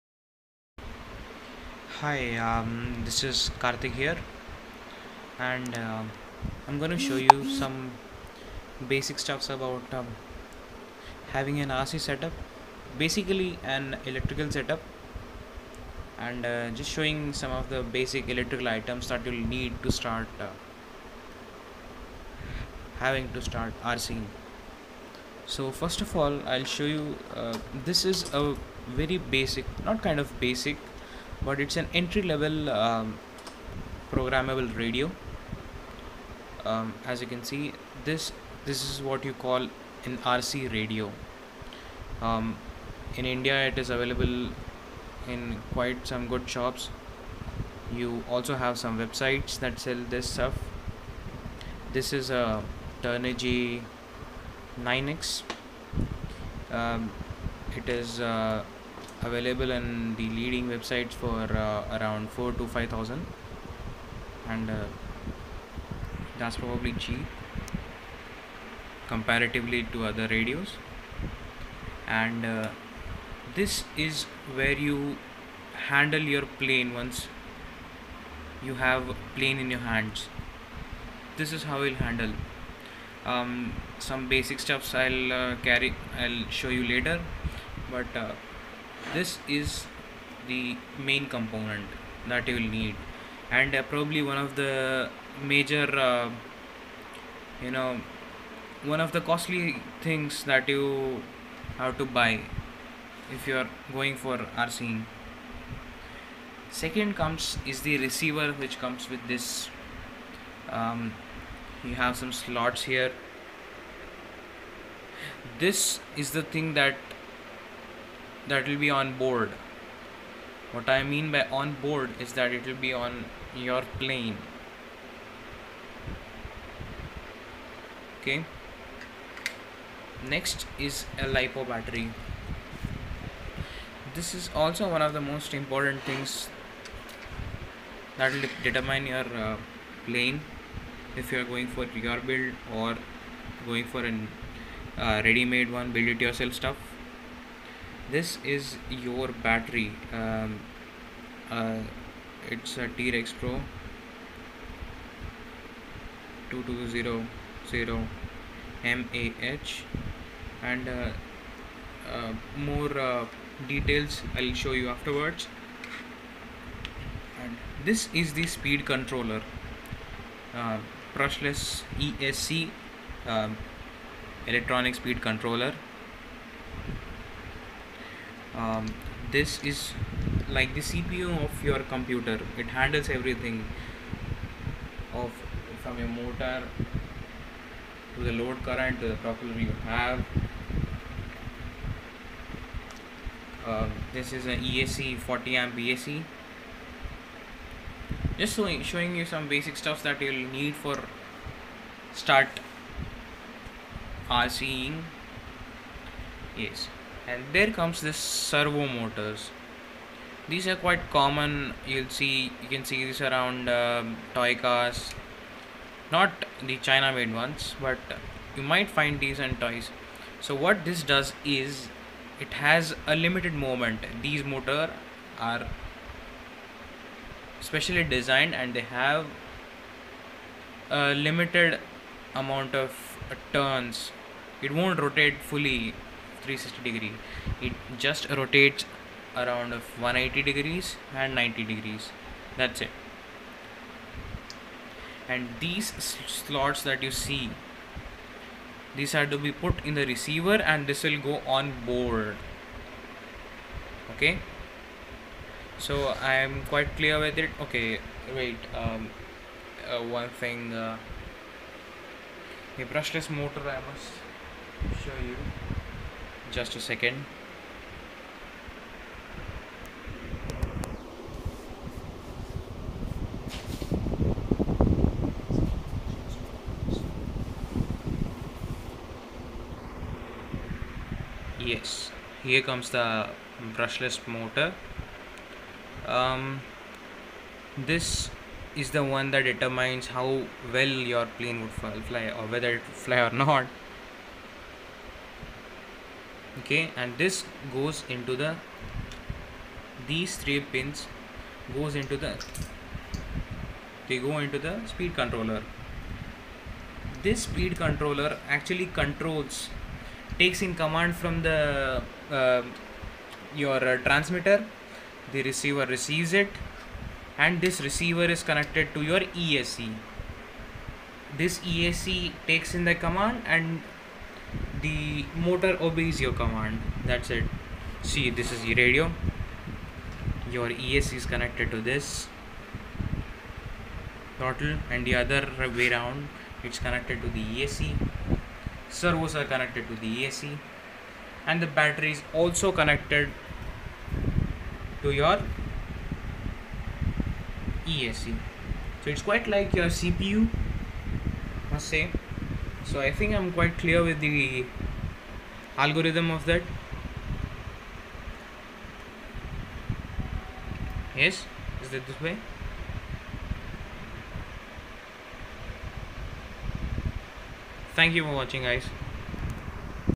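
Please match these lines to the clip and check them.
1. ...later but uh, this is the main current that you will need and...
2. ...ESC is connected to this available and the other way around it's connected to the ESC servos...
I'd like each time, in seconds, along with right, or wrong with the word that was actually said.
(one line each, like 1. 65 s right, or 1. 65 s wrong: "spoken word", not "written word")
1. 86 s wrong: "component", not "current"
2. 330 s wrong: "throttle", not "available".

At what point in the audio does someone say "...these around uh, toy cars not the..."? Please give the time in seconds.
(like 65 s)
213 s.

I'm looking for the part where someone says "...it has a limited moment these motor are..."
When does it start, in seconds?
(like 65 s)
222 s.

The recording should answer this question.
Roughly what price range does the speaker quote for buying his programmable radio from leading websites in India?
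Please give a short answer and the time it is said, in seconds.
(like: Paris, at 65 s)
4 to 5000, at 62 s.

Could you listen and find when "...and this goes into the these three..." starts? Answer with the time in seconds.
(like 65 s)
296 s.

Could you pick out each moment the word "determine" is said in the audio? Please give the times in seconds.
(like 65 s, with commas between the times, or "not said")
138 s, 289 s.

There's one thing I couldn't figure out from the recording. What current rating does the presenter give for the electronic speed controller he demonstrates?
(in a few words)
40 amp.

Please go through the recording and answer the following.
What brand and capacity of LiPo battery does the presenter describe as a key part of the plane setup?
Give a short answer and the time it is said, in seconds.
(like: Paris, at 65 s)
T-Rex Pro 2200 mAh, at 152 s.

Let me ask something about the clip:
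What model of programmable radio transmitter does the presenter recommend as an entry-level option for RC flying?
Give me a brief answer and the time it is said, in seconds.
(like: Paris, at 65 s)
Turnigy 9x, at 53 s.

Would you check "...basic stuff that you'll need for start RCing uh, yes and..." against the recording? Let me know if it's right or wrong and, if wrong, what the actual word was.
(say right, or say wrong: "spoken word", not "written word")
right.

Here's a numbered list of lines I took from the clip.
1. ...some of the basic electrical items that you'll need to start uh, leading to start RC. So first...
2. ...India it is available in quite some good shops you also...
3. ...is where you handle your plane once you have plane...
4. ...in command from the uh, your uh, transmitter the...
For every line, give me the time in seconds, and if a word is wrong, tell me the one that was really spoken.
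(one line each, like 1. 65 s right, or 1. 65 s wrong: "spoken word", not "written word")
1. 17 s wrong: "having", not "leading"
2. 43 s right
3. 73 s right
4. 310 s right.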